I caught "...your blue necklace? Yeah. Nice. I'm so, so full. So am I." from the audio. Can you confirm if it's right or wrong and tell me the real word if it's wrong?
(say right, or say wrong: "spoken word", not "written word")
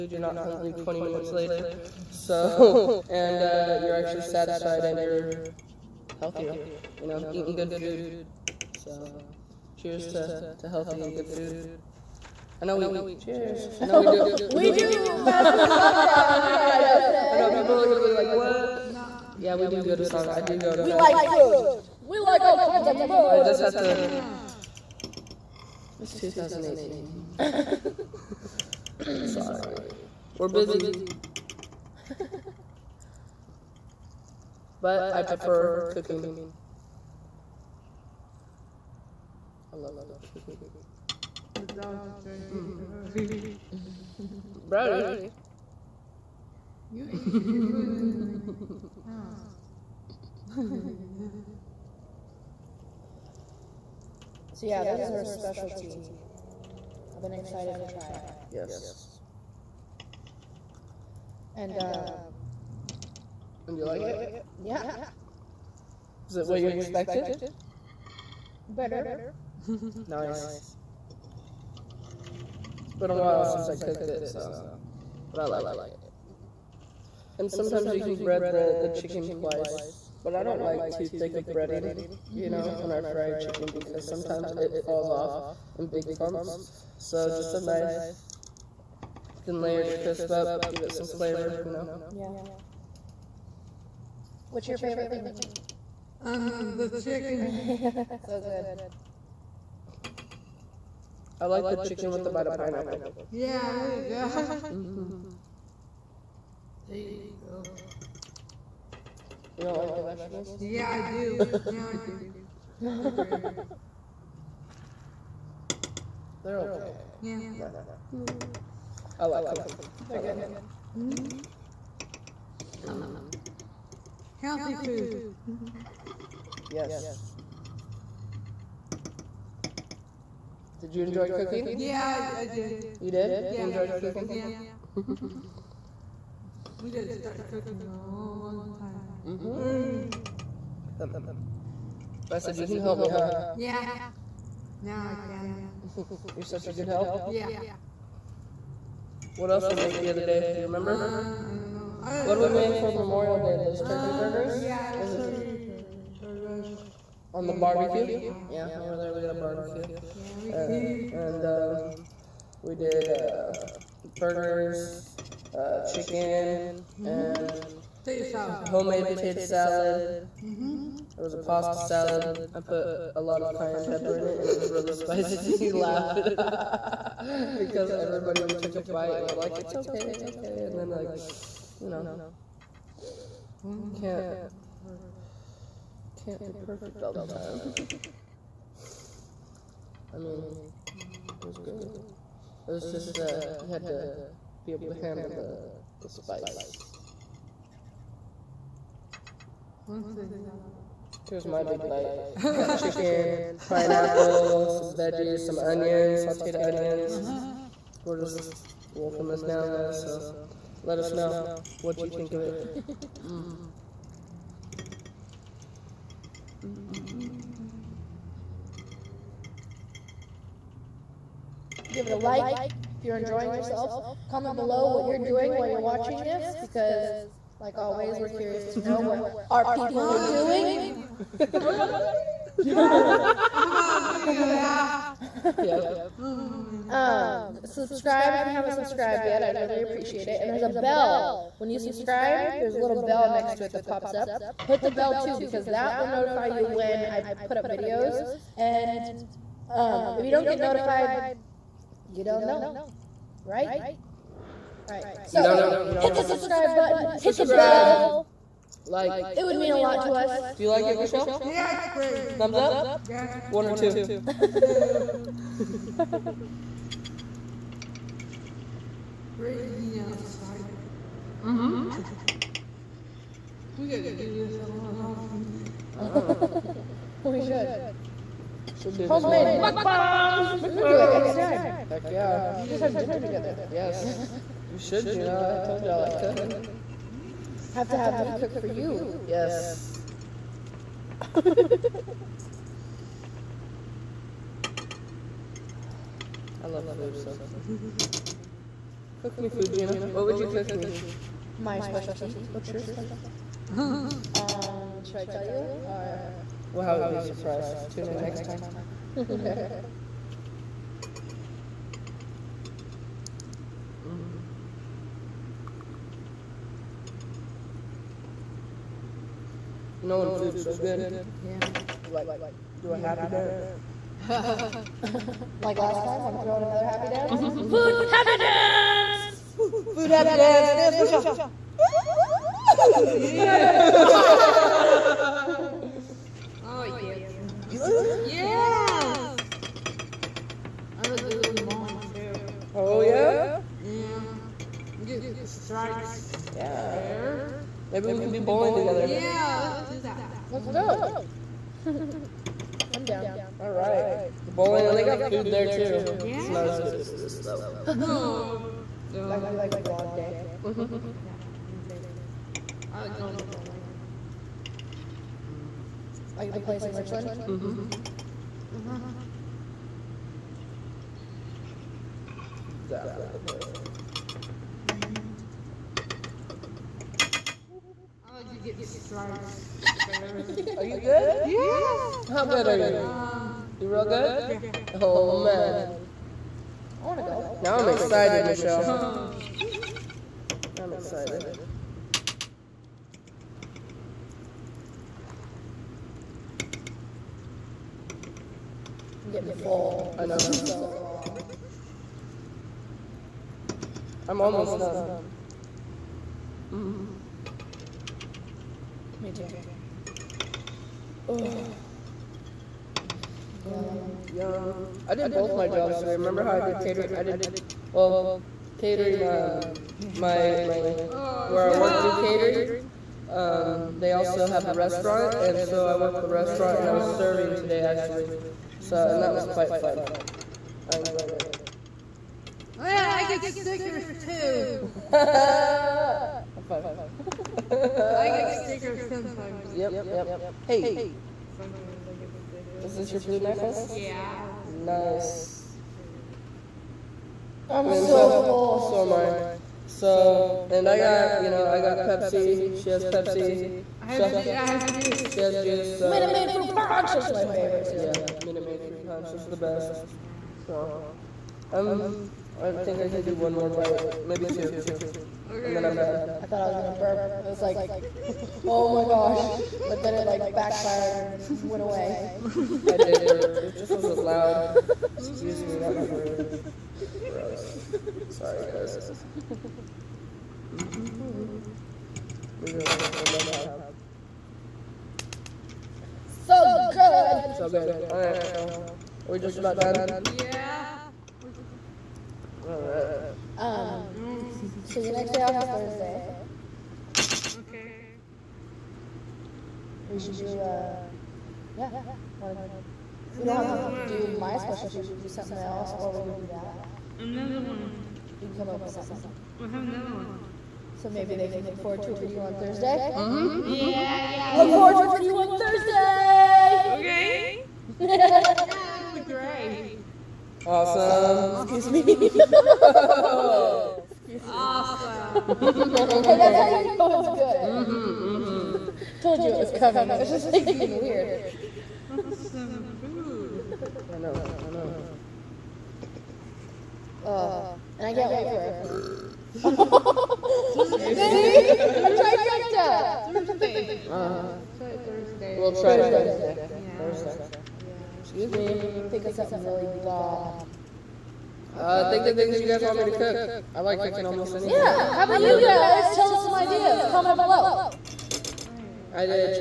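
right.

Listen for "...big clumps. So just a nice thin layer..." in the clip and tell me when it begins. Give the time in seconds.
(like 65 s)
85 s.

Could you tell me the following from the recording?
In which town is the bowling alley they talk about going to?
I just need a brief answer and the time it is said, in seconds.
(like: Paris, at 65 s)
Richland, at 366 s.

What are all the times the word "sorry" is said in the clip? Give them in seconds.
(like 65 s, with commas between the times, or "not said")
29 s, 478 s.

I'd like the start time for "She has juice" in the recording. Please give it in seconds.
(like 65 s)
455 s.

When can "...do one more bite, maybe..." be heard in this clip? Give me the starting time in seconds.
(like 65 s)
463 s.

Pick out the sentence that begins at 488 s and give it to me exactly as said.
All right, so we're just about done.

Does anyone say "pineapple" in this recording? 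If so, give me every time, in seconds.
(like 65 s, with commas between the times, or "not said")
102 s, 203 s.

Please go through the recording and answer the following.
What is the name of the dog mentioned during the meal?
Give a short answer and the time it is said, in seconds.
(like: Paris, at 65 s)
Brody, at 44 s.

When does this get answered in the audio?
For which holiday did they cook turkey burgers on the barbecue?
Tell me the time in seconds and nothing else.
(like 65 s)
152 s.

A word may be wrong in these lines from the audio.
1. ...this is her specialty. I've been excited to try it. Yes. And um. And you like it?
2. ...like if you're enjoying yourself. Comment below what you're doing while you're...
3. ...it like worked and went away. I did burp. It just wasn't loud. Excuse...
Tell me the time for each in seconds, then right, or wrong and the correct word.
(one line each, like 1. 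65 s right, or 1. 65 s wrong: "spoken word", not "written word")
1. 54 s right
2. 222 s right
3. 470 s wrong: "backfired", not "worked".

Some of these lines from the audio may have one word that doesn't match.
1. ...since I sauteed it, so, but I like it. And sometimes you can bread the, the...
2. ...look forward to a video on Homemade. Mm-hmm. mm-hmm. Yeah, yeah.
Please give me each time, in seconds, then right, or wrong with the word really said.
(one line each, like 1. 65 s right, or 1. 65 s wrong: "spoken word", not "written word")
1. 73 s wrong: "cooked", not "sauteed"
2. 511 s wrong: "Thursday", not "Homemade".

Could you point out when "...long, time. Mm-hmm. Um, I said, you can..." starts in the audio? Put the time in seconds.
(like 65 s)
138 s.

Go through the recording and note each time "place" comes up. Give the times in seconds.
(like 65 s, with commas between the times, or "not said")
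366 s, 373 s.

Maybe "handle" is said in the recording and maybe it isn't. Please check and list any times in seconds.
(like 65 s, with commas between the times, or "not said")
194 s.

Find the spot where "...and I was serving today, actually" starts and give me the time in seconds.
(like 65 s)
426 s.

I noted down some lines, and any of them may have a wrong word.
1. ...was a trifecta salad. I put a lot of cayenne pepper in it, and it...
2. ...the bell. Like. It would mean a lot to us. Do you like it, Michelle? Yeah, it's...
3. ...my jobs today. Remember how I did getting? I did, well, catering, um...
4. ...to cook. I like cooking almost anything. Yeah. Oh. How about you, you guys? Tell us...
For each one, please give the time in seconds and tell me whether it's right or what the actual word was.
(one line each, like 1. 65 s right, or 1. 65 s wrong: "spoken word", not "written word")
1. 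171 s wrong: "pasta", not "trifecta"
2. 257 s right
3. 415 s wrong: "catering", not "getting"
4. 553 s right.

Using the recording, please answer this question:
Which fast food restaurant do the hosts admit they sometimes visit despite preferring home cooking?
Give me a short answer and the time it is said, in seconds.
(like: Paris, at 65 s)
Sonic, at 20 s.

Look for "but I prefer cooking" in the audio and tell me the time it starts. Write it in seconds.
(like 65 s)
34 s.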